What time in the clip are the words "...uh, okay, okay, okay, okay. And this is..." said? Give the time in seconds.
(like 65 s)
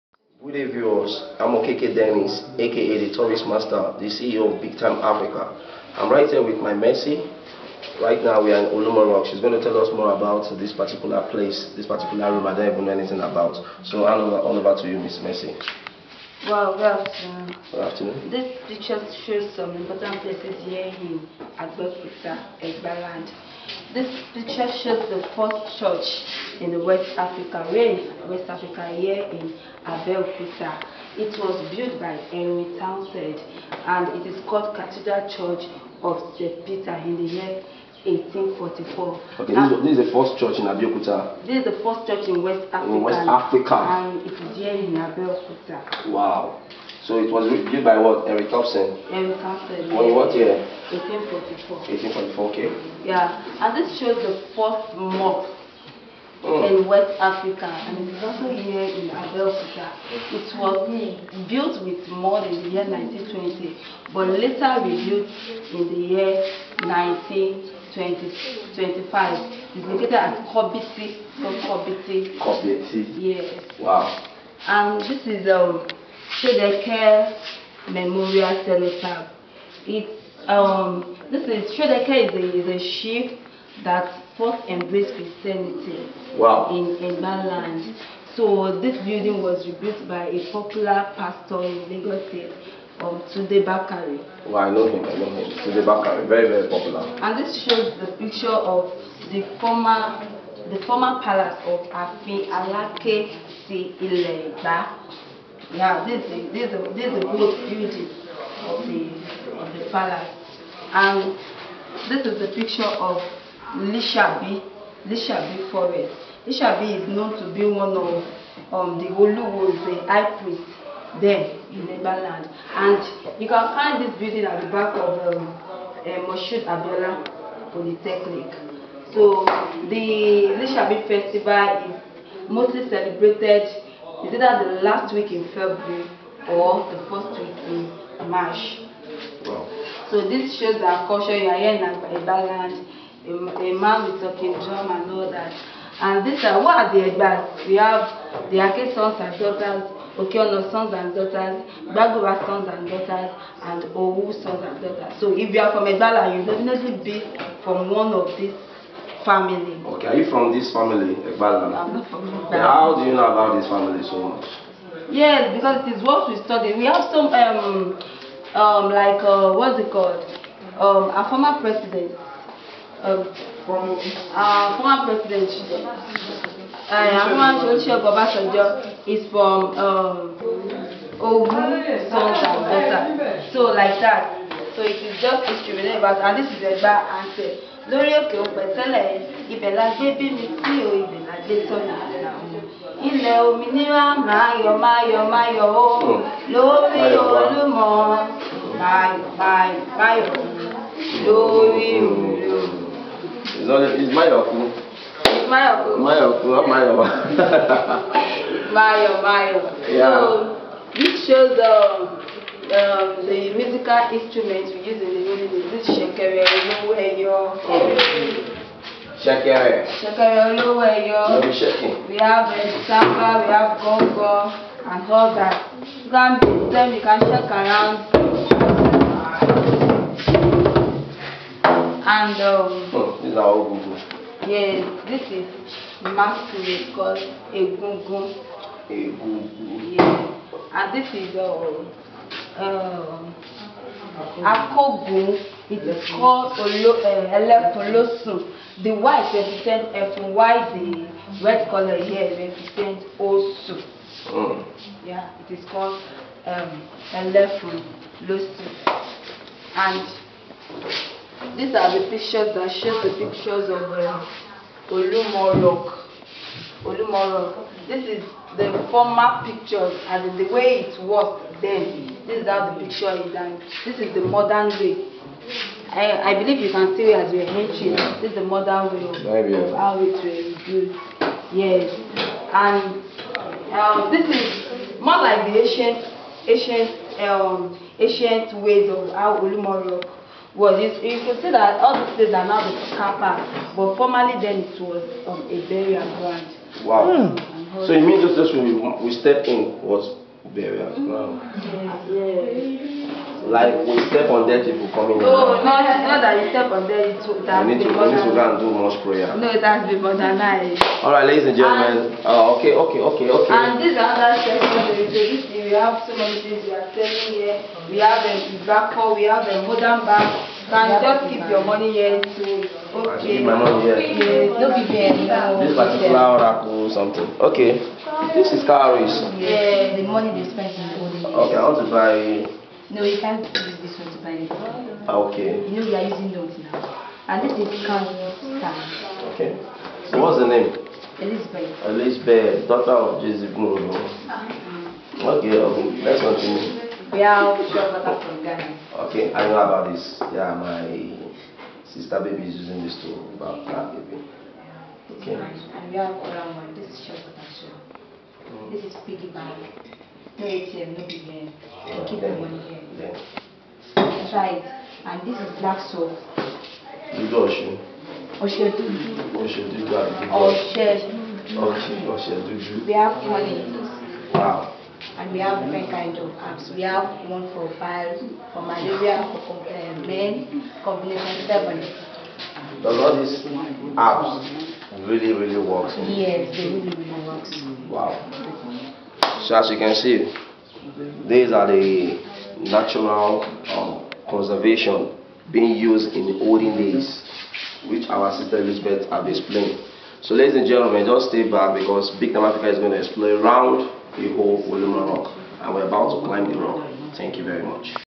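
312 s.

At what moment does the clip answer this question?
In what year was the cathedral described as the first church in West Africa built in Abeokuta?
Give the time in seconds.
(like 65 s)
37 s.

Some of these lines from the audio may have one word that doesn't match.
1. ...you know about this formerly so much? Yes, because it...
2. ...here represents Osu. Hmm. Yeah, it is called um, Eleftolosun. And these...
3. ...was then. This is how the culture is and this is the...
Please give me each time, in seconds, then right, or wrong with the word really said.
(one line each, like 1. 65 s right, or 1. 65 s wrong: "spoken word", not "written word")
1. 163 s wrong: "family", not "formerly"
2. 251 s right
3. 271 s wrong: "picture", not "culture".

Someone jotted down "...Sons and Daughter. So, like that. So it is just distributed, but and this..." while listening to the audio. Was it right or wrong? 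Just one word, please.
right.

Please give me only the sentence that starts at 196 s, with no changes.
lórí olúmọ máa yọ máa yọ máa yọ lórí olúmọ.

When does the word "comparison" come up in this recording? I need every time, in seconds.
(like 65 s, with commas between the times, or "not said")
not said.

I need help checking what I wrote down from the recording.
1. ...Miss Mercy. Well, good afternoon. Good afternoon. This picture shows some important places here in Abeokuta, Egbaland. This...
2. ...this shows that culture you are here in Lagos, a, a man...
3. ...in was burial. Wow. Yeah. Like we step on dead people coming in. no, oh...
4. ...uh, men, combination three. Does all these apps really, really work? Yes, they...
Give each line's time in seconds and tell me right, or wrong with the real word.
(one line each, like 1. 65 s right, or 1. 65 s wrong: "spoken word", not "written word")
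1. 14 s right
2. 140 s wrong: "Ibaland", not "Lagos"
3. 299 s right
4. 379 s wrong: "seven", not "three".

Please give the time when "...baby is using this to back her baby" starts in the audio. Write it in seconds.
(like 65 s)
352 s.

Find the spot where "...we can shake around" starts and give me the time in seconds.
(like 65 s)
226 s.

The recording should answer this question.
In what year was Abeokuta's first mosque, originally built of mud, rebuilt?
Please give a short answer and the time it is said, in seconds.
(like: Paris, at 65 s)
1925, at 64 s.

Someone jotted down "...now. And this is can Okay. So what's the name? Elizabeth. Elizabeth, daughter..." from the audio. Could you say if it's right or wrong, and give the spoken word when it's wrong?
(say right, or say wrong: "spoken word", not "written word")
right.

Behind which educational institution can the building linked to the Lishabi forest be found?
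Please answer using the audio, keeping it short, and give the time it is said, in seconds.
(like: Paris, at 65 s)
Moshood Abiola Polytechnic, at 126 s.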